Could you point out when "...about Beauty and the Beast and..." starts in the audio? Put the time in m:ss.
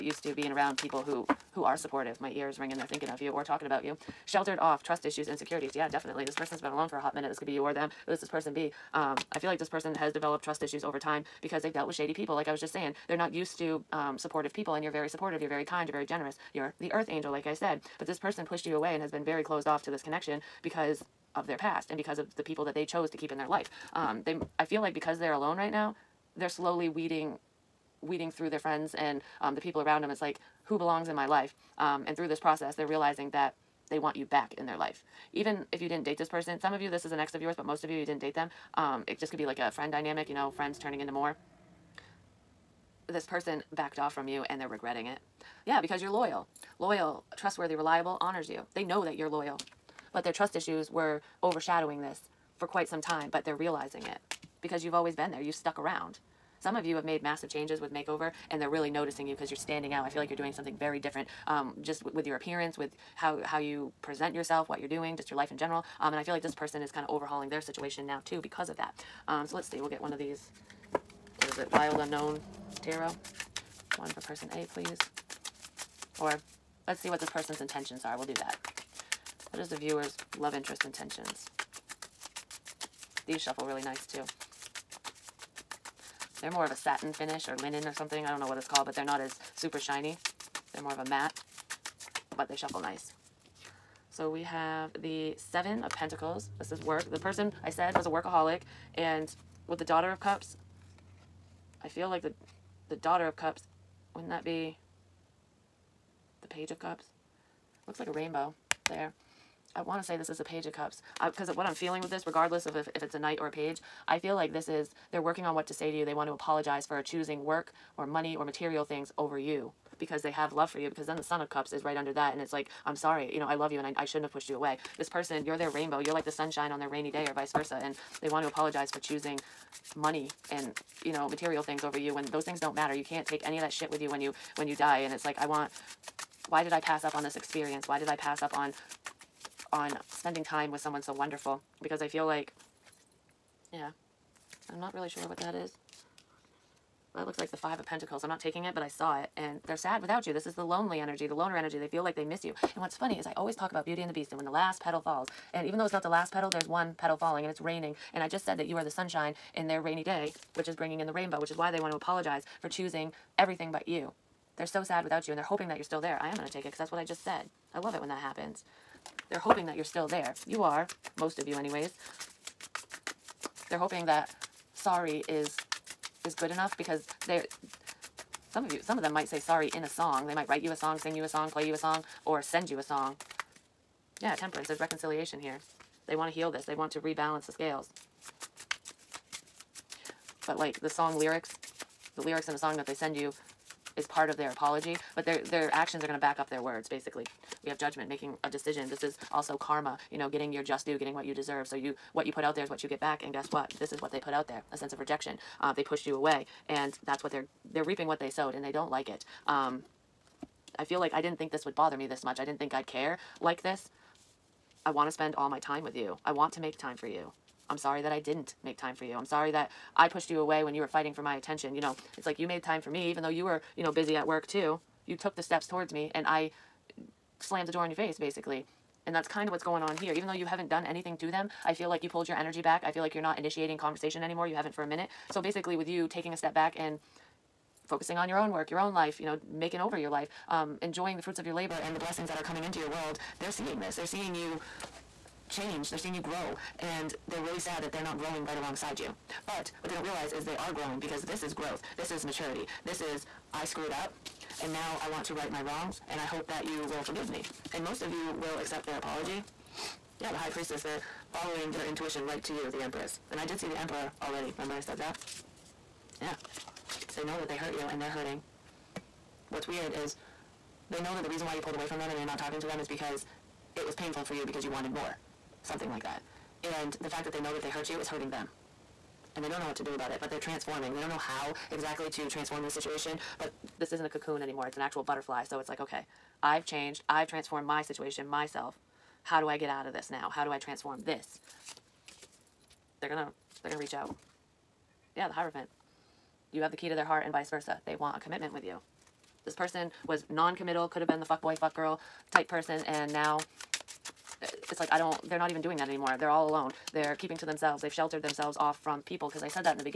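2:33.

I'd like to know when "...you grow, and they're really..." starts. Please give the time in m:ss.
4:06.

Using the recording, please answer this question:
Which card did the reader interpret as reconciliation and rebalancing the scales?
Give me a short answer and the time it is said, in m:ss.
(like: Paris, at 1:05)
Temperance, at 3:04.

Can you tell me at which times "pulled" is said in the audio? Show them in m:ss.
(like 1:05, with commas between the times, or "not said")
3:52, 4:31.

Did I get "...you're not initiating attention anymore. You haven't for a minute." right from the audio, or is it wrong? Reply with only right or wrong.
wrong.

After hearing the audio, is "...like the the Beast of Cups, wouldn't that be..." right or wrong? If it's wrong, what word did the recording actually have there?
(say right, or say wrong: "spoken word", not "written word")
wrong: "Daughter", not "Beast".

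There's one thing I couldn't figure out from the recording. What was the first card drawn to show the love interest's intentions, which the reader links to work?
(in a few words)
Seven of Pentacles.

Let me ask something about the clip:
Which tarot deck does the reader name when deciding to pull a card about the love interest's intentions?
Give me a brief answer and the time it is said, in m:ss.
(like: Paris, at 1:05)
Wild Unknown Tarot, at 1:11.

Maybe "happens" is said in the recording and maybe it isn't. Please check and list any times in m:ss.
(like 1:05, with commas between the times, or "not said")
2:48.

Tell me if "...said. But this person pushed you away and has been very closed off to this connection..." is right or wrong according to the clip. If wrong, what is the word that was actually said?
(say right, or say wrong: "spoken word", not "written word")
right.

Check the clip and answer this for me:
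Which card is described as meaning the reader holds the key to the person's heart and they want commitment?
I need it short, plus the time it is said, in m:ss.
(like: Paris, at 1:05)
The Hierophant, at 4:55.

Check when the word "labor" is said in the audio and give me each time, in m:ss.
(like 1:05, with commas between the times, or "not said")
4:01.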